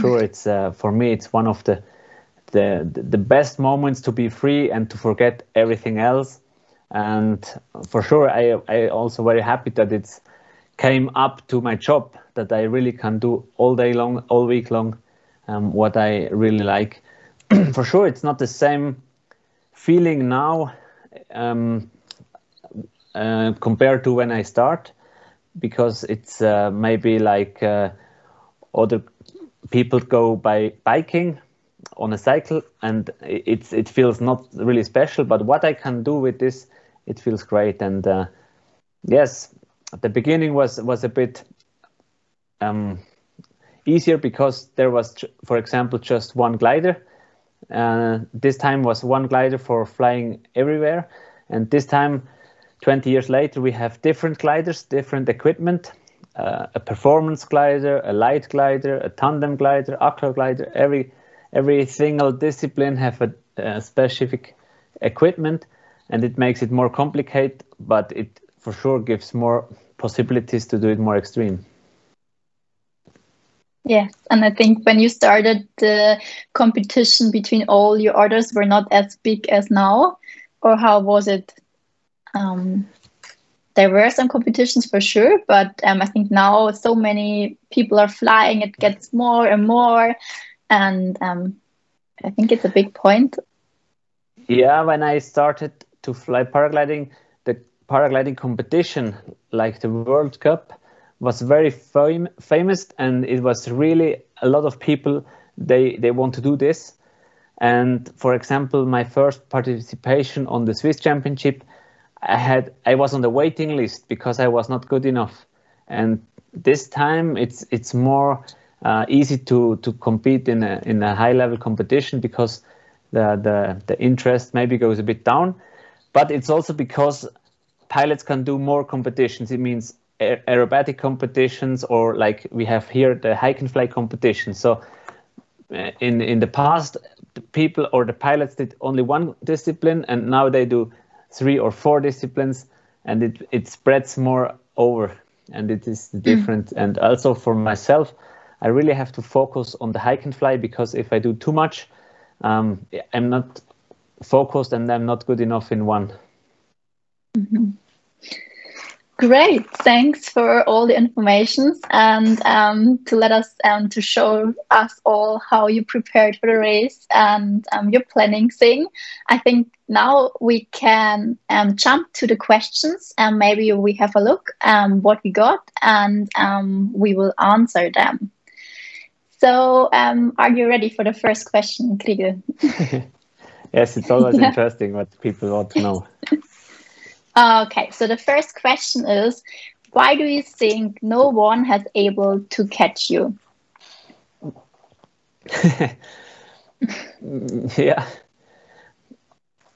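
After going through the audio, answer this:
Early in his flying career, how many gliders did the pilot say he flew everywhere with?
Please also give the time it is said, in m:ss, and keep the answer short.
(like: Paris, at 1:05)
1, at 0:45.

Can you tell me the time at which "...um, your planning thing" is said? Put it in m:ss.
2:47.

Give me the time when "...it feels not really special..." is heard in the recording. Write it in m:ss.
0:33.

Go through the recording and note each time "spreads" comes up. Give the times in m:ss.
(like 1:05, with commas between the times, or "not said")
2:23.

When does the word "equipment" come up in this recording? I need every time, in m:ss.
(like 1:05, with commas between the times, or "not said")
0:55, 1:05.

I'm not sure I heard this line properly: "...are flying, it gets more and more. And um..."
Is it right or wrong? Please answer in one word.
right.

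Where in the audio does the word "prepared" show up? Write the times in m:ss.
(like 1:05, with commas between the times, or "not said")
2:45.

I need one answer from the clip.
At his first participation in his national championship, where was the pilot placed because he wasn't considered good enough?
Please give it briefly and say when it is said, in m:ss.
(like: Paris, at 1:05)
waiting list, at 1:53.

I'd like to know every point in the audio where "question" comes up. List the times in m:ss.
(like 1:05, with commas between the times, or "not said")
2:52, 3:01, 3:08.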